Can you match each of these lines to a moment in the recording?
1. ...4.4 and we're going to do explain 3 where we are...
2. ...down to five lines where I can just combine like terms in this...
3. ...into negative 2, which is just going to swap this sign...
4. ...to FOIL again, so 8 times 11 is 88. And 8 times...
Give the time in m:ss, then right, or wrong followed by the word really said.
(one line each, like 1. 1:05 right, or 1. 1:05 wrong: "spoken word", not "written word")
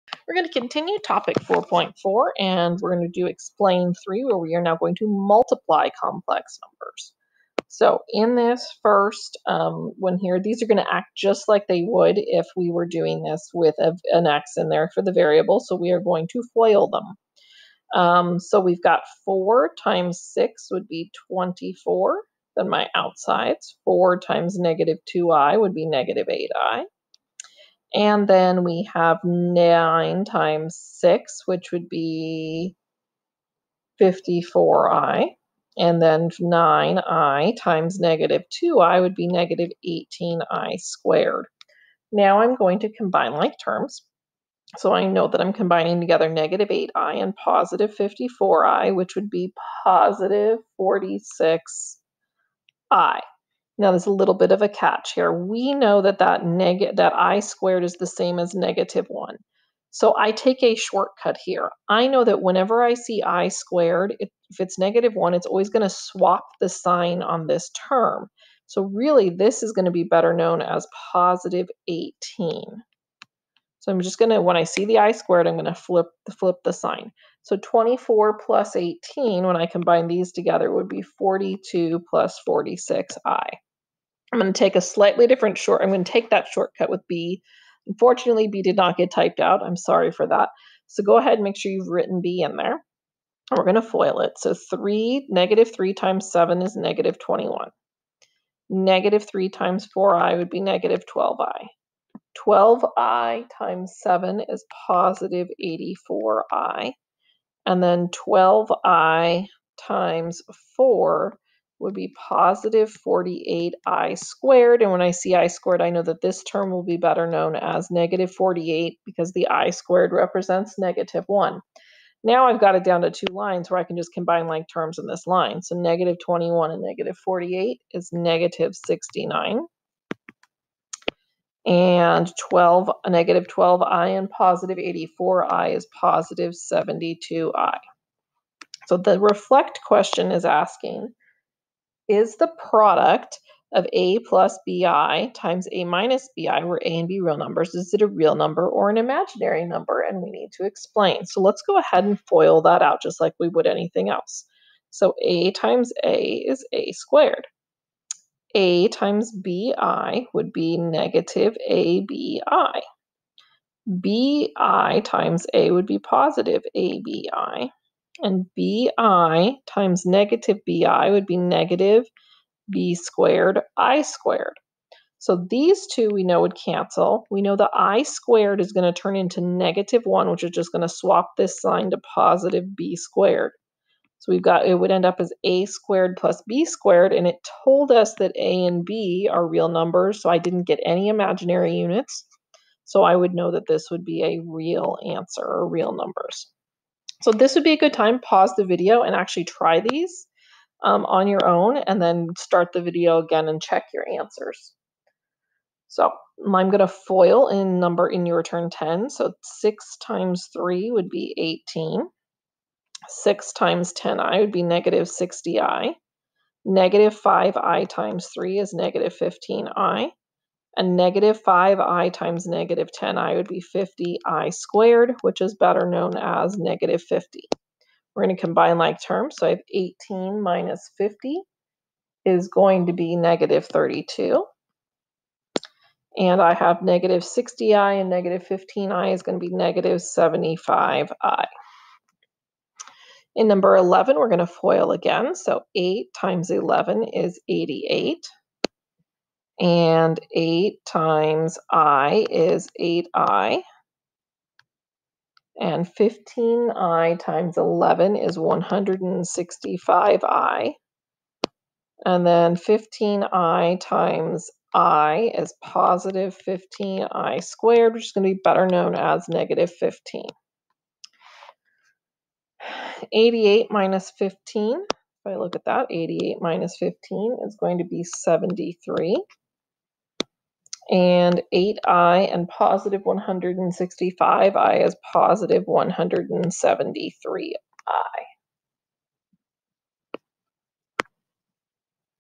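1. 0:01 right
2. 2:02 wrong: "two", not "five"
3. 2:59 wrong: "1", not "2"
4. 4:04 right.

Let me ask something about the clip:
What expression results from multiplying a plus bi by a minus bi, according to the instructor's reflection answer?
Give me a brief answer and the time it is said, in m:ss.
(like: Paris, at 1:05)
a² + b², at 3:05.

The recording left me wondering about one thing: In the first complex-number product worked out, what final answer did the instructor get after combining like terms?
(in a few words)
42 + 46i.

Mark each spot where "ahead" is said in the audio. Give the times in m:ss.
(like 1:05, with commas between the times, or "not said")
1:31, 2:31.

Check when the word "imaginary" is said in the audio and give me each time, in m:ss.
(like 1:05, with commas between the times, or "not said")
2:28, 3:11.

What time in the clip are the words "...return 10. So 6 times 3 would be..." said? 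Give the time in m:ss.
3:28.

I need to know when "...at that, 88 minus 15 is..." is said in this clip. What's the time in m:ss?
4:35.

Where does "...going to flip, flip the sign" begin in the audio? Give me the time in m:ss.
1:15.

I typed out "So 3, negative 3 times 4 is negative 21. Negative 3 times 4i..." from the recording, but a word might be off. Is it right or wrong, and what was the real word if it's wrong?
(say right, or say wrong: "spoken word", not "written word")
wrong: "7", not "4".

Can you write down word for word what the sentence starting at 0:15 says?
So we are going to FOIL them.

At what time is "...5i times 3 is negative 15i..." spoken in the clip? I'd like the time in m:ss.
3:37.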